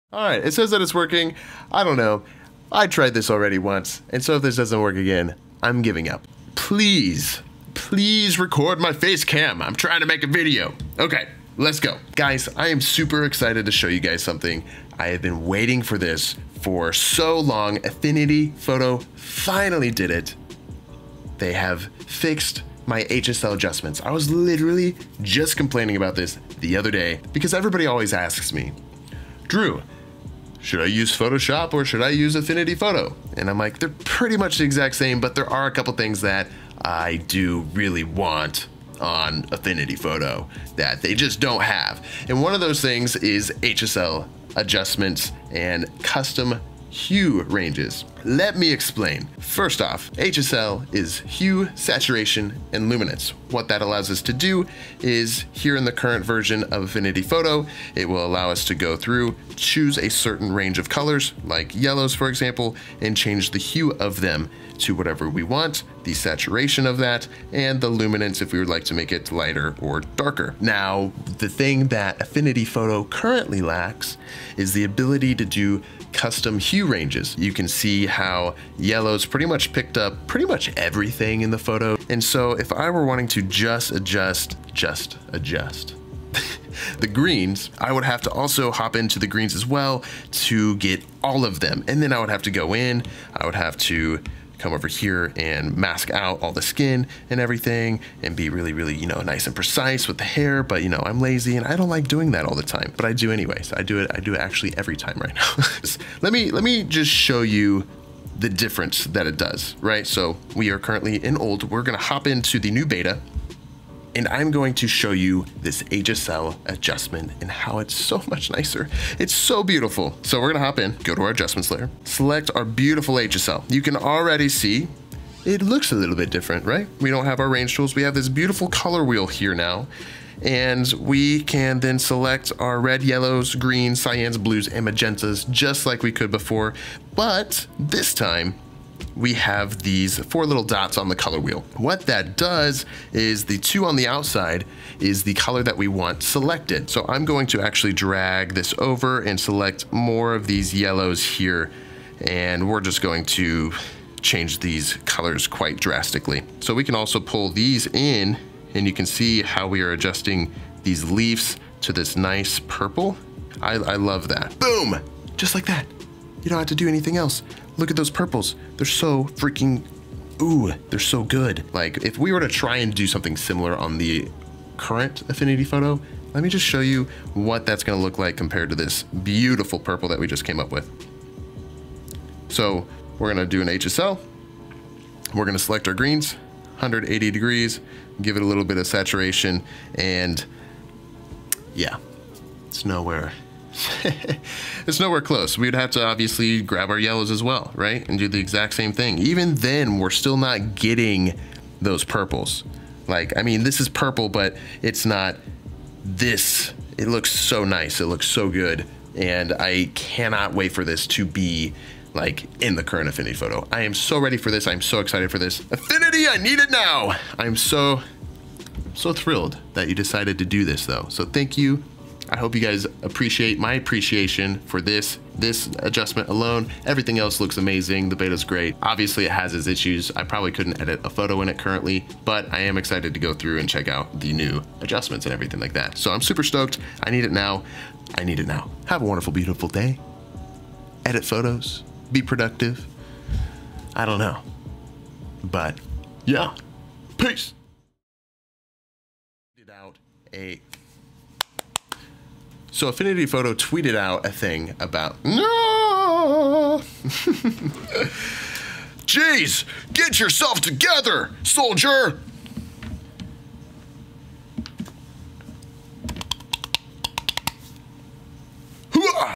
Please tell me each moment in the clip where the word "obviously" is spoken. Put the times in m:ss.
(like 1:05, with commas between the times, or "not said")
3:16, 3:48.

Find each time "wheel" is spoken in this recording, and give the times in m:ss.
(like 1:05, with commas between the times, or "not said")
2:09, 2:21.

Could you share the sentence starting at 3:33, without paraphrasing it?
I am so ready for this.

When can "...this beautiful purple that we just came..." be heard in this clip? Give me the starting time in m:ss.
2:58.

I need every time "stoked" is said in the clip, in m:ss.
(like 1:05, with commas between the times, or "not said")
3:56.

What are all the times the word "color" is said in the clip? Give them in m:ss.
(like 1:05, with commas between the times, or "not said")
1:00, 2:08, 2:21, 2:25, 2:35.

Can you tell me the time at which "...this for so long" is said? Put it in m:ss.
0:15.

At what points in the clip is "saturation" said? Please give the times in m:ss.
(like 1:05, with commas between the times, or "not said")
0:51, 1:06, 3:08.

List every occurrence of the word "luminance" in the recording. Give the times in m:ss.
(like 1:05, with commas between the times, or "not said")
0:52, 1:07.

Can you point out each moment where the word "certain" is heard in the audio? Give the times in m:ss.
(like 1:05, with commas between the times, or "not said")
1:00.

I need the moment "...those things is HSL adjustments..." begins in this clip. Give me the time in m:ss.
0:42.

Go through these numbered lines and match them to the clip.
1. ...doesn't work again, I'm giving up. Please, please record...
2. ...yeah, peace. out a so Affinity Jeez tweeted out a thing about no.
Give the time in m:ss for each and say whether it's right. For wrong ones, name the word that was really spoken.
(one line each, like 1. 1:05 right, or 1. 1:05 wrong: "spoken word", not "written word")
1. 0:04 right
2. 4:06 wrong: "Photo", not "Jeez".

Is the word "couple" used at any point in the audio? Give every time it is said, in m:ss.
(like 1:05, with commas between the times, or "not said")
0:35.